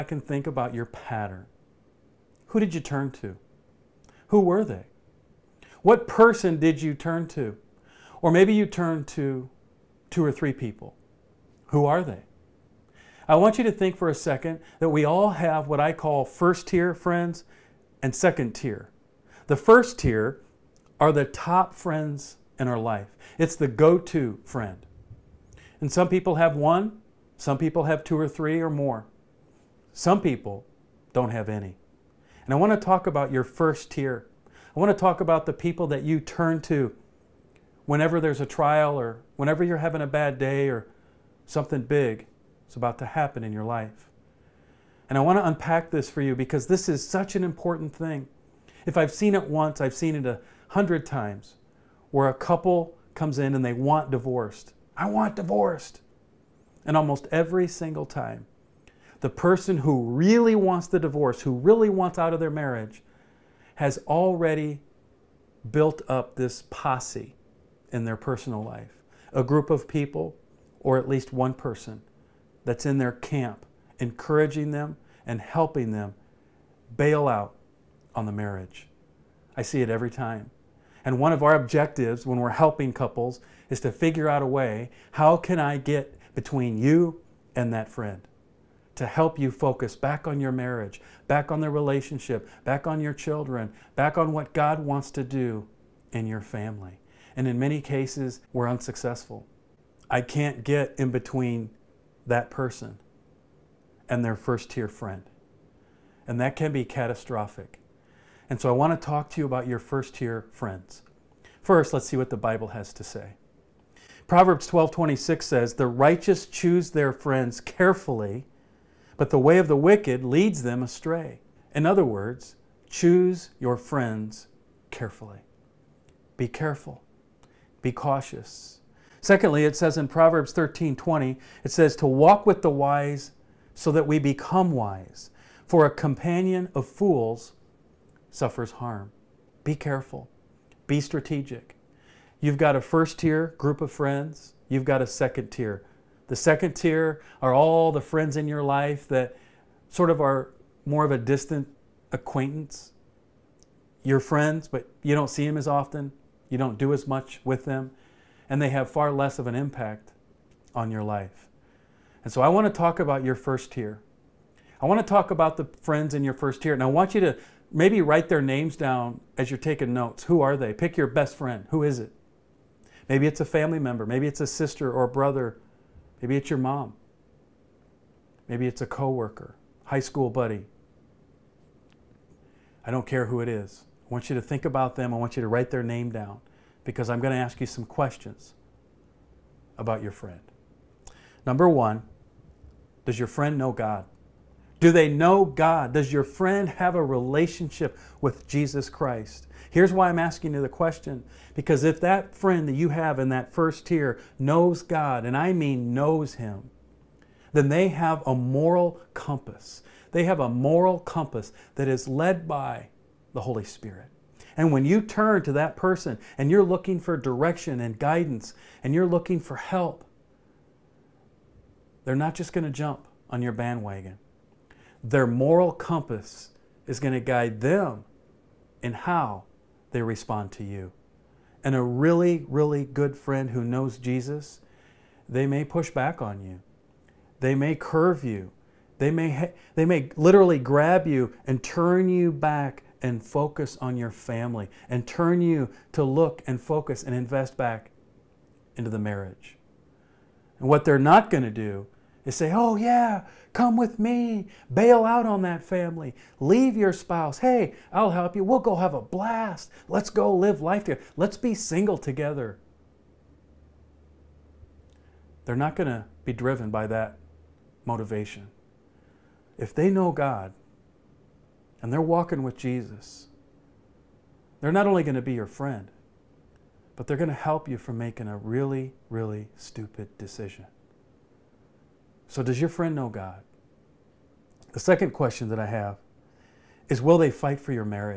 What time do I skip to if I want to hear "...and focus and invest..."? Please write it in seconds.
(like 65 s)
246 s.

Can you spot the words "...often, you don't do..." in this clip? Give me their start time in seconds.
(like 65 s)
155 s.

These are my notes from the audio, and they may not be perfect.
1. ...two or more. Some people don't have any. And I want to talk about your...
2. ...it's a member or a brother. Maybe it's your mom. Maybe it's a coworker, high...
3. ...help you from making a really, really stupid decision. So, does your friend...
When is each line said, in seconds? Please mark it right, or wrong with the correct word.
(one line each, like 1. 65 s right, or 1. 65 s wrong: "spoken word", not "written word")
1. 28 s wrong: "three", not "two"
2. 174 s wrong: "sister", not "member"
3. 277 s right.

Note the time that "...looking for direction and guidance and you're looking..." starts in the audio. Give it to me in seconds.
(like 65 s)
216 s.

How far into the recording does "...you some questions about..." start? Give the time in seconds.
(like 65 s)
187 s.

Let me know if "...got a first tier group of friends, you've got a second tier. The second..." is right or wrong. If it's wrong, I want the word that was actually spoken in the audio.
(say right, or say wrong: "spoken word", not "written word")
right.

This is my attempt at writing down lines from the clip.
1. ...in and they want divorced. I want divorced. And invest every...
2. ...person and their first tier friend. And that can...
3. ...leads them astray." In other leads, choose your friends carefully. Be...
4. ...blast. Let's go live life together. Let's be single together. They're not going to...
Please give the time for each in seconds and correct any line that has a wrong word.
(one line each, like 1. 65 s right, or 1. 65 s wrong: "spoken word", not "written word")
1. 53 s wrong: "almost", not "invest"
2. 102 s right
3. 120 s wrong: "words", not "leads"
4. 259 s right.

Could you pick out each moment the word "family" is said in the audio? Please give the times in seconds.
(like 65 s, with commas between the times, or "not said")
96 s, 173 s, 244 s, 255 s.